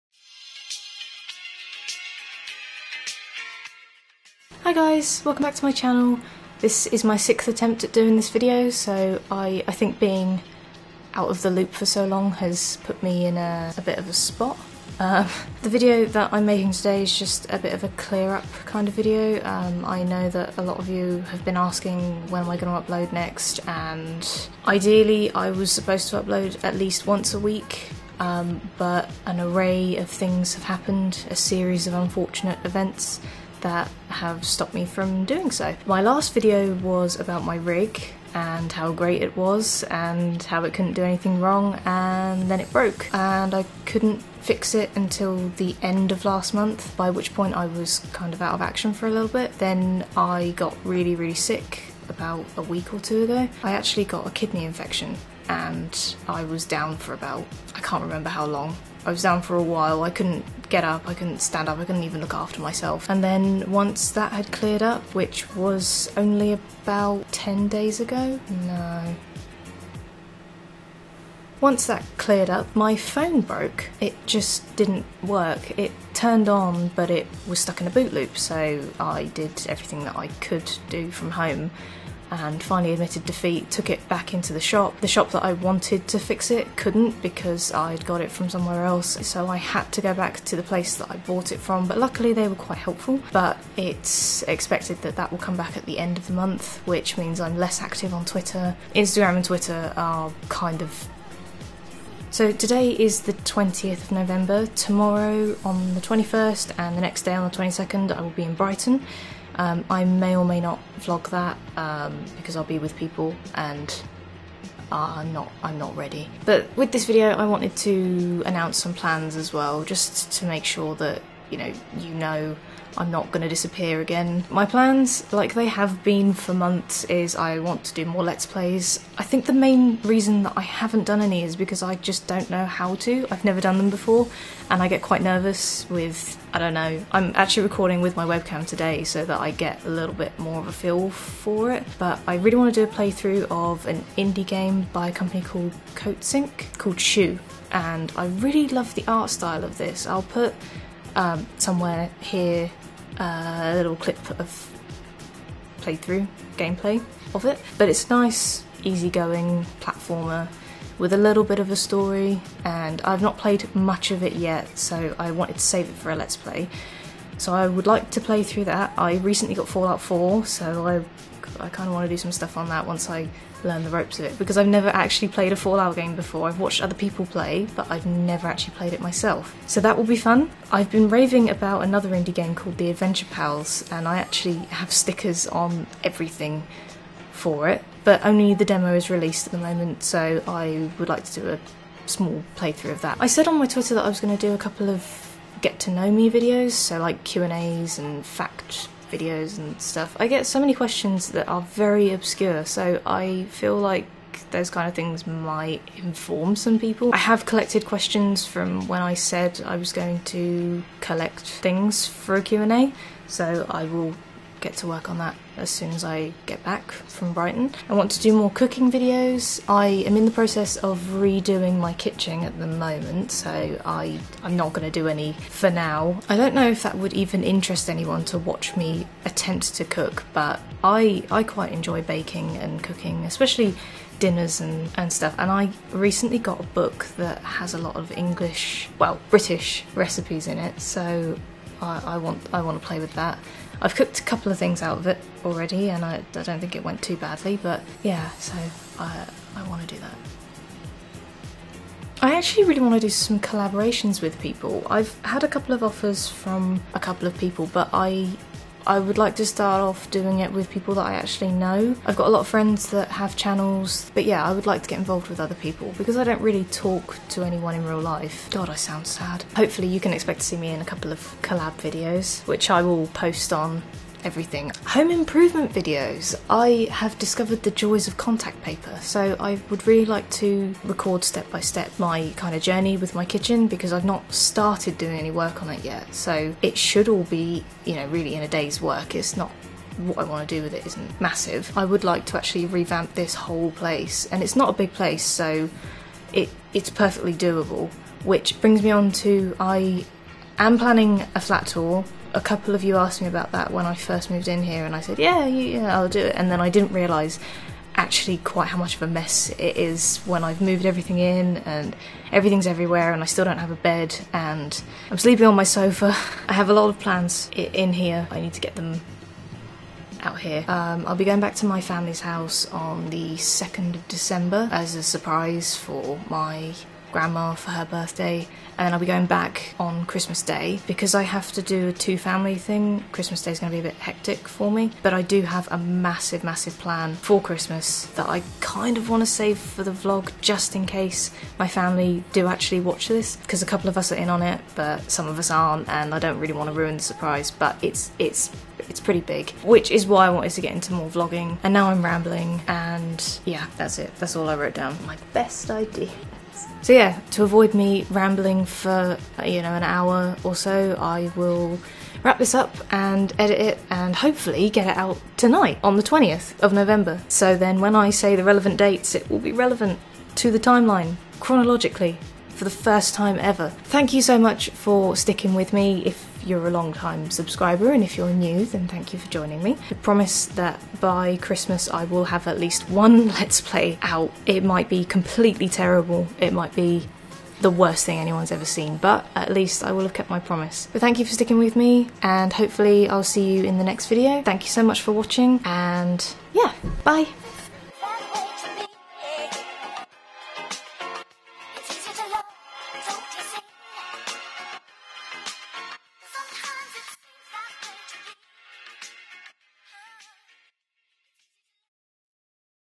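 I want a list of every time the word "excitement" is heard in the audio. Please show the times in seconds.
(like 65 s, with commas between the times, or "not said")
not said.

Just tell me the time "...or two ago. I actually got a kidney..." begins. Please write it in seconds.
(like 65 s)
52 s.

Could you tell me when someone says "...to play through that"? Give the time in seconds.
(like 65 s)
168 s.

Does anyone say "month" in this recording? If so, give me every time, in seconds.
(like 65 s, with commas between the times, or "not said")
46 s, 96 s, 126 s.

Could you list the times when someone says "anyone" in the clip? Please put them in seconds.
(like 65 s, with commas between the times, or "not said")
227 s, 267 s, 388 s.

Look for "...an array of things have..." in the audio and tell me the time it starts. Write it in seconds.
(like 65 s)
29 s.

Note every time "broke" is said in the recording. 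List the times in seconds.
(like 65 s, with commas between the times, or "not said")
42 s, 73 s.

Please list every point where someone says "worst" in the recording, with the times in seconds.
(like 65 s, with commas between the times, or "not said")
387 s.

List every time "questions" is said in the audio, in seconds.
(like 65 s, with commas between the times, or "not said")
200 s, 207 s.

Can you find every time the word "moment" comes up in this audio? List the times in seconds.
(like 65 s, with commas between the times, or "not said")
189 s, 222 s.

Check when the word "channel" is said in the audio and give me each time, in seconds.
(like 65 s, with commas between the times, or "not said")
5 s, 263 s.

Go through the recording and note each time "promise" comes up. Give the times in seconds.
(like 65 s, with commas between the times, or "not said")
379 s, 390 s.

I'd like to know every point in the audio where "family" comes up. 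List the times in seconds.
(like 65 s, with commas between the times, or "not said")
321 s, 332 s, 341 s.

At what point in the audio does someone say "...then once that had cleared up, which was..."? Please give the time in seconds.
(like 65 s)
63 s.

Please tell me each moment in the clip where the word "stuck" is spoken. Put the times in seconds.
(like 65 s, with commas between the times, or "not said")
77 s.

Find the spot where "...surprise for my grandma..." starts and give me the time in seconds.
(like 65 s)
325 s.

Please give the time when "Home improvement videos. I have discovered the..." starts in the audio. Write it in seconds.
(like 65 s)
274 s.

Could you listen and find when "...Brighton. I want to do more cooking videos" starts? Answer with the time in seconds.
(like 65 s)
217 s.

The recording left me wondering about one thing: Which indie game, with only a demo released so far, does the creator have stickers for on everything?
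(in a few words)
The Adventure Pals.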